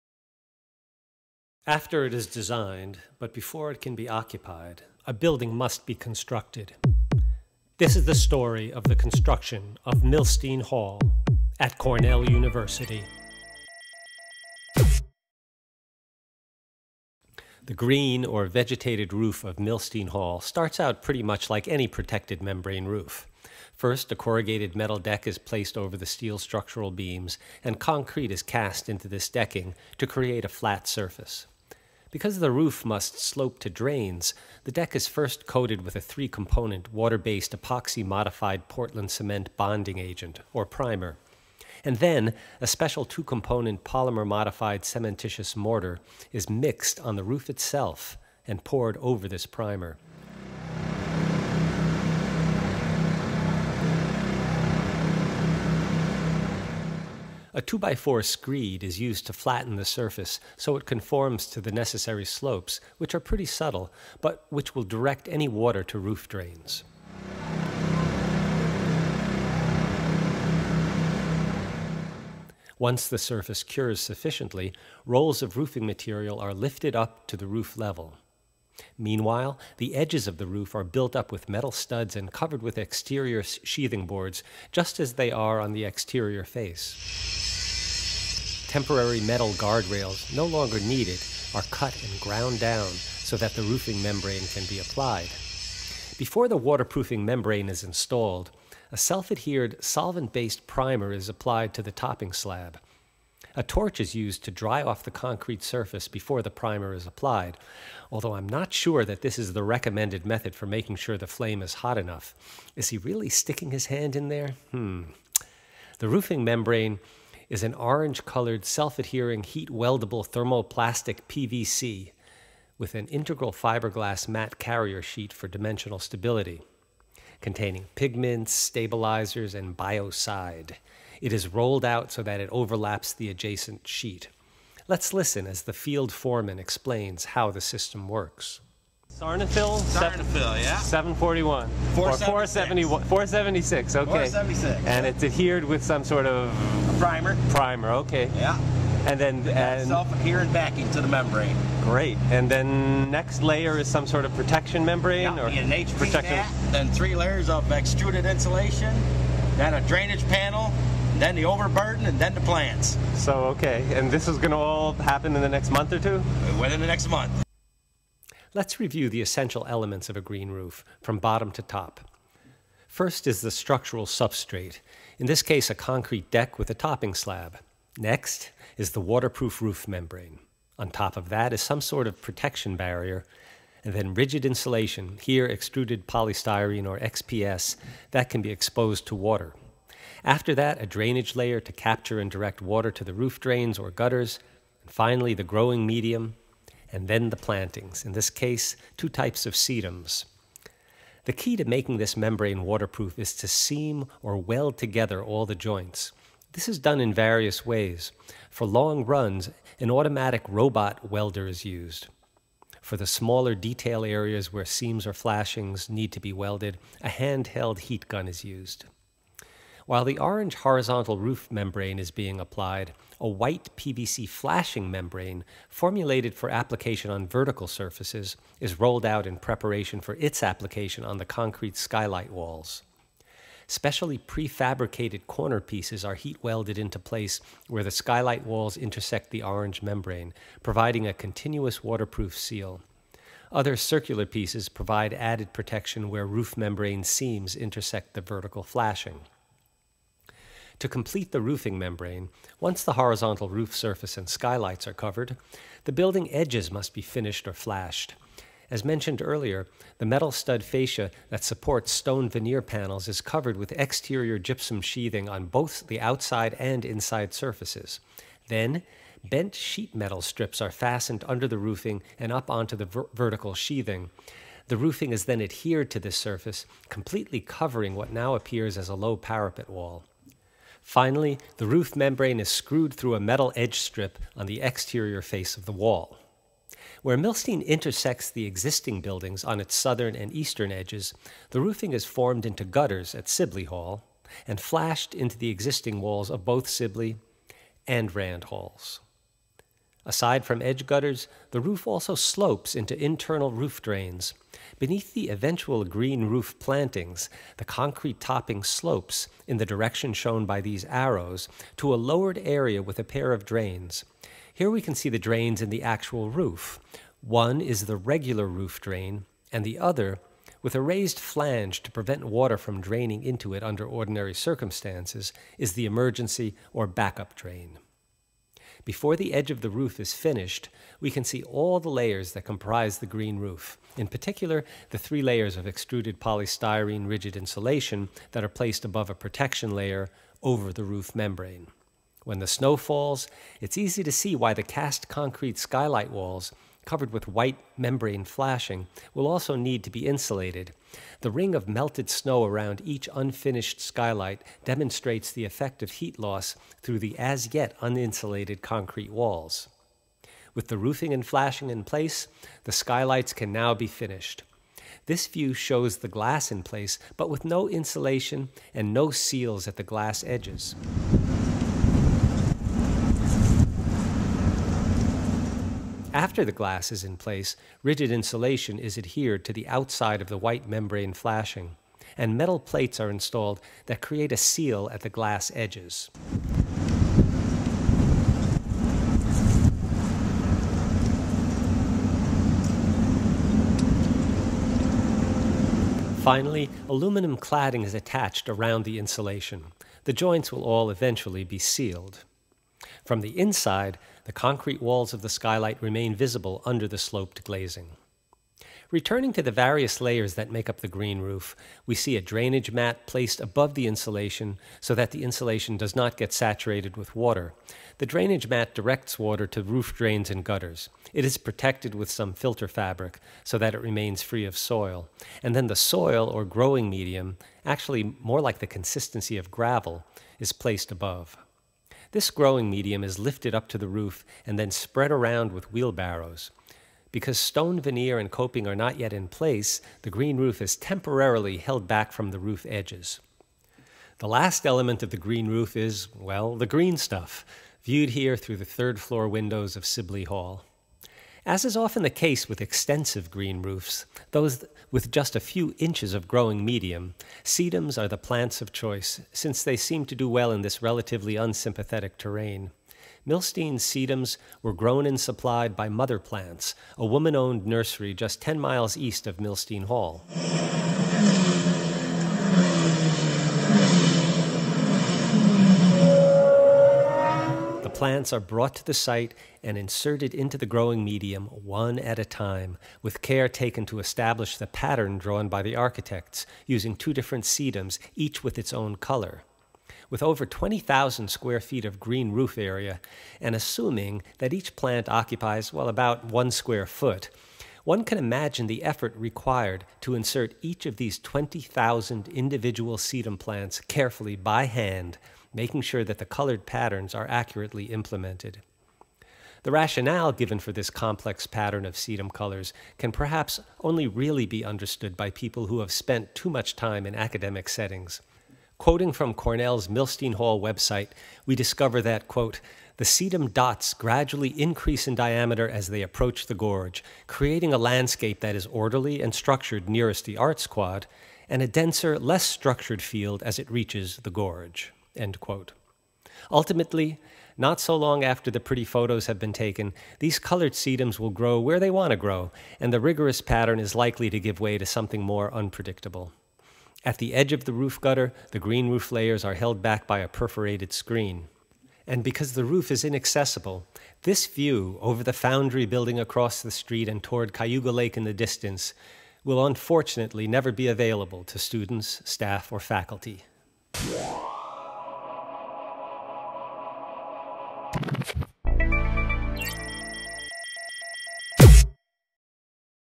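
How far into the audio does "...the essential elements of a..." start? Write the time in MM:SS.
02:49.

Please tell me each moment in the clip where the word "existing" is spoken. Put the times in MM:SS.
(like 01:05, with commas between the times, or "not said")
04:48, 04:55.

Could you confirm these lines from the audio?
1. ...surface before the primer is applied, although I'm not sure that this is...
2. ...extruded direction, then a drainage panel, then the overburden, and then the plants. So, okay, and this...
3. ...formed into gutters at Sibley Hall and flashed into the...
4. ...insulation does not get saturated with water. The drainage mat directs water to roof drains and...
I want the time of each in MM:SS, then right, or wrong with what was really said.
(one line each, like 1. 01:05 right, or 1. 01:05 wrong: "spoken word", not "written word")
1. 01:45 right
2. 02:37 wrong: "insulation", not "direction"
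3. 04:52 right
4. 06:55 right.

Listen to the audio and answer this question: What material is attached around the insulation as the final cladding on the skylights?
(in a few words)
aluminum cladding.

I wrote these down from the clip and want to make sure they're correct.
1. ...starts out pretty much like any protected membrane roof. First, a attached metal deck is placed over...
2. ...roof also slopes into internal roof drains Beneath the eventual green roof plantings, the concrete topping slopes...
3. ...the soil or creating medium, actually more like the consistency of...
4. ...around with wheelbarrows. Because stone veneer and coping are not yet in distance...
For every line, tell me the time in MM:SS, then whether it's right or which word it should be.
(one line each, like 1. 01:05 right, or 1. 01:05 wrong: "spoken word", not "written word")
1. 00:20 wrong: "corrugated", not "attached"
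2. 05:01 right
3. 07:05 wrong: "growing", not "creating"
4. 07:15 wrong: "place", not "distance".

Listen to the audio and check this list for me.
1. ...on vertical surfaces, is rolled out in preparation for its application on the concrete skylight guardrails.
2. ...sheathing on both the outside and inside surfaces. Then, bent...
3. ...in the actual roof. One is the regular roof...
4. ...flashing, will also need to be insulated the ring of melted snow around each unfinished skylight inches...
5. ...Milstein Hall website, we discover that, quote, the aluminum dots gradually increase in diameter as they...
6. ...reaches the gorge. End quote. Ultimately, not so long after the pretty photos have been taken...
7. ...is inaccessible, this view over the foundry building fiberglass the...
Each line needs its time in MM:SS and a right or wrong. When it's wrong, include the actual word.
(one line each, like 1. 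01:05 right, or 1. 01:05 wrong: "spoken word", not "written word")
1. 03:47 wrong: "walls", not "guardrails"
2. 04:24 right
3. 05:15 right
4. 05:48 wrong: "demonstrates", not "inches"
5. 08:39 wrong: "sedum", not "aluminum"
6. 08:53 right
7. 09:12 wrong: "across", not "fiberglass".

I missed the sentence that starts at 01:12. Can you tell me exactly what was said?
Once the surface cures sufficiently, rolls of roofing material are lifted up to the roof level.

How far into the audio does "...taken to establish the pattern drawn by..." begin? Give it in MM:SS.
08:03.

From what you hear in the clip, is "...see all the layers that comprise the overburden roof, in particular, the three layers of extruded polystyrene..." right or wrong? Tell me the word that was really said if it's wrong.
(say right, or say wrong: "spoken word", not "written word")
wrong: "green", not "overburden".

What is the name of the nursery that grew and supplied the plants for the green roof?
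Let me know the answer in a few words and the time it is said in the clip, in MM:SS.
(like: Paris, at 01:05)
Mother Plants, at 07:45.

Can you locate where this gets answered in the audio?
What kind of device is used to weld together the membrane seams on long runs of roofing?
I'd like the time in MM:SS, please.
03:29.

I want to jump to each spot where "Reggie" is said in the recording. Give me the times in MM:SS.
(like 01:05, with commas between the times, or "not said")
not said.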